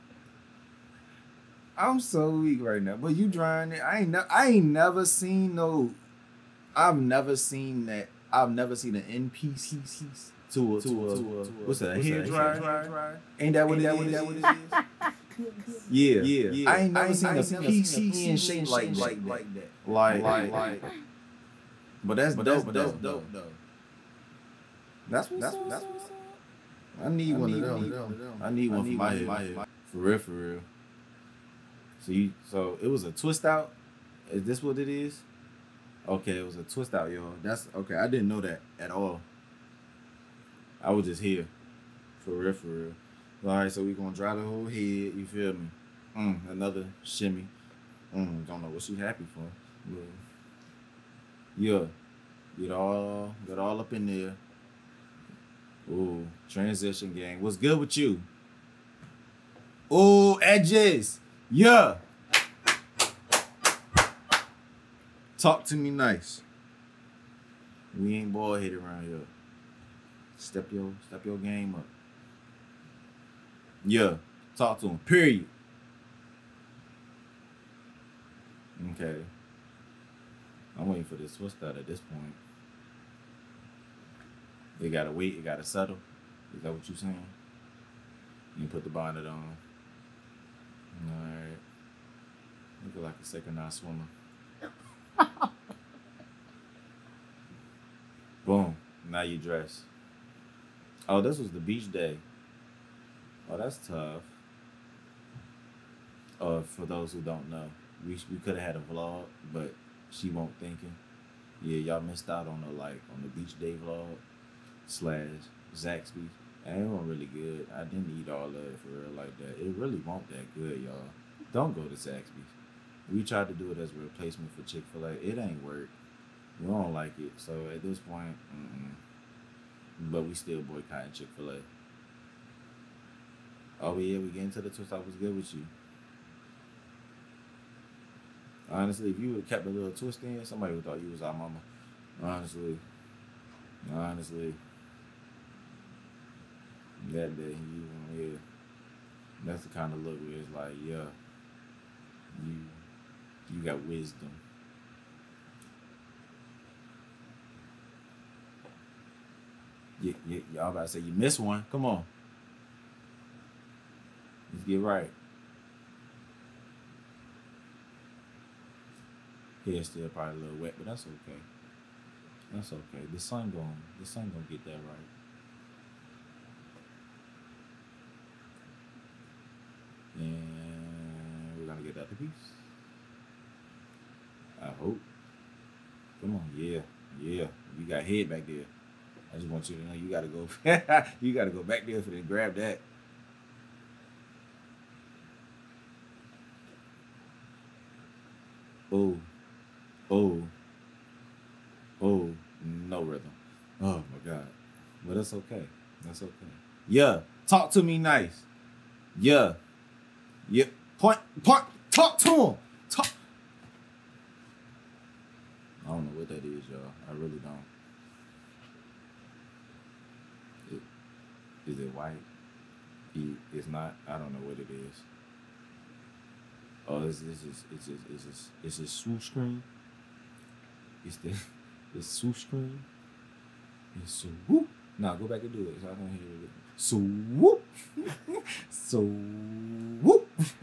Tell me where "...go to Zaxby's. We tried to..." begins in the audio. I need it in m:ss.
2:01.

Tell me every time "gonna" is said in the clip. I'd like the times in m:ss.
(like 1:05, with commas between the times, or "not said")
0:43, 2:54, 3:01.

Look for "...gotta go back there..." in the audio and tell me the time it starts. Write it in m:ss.
3:11.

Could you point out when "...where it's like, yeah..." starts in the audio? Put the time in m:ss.
2:30.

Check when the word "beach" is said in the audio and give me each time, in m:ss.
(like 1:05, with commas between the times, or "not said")
1:41, 1:53.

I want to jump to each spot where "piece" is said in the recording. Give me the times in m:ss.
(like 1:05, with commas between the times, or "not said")
0:09, 0:17, 3:02.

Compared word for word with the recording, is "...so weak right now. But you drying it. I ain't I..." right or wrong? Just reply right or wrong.
right.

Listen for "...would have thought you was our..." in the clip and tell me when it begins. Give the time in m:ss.
2:20.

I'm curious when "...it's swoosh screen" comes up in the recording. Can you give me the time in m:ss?
3:51.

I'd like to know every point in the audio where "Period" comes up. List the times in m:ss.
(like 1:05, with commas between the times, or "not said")
1:15.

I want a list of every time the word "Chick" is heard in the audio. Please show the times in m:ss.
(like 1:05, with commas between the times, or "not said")
2:04, 2:11.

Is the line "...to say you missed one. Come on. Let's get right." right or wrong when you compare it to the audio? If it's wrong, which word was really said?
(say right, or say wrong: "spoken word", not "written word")
right.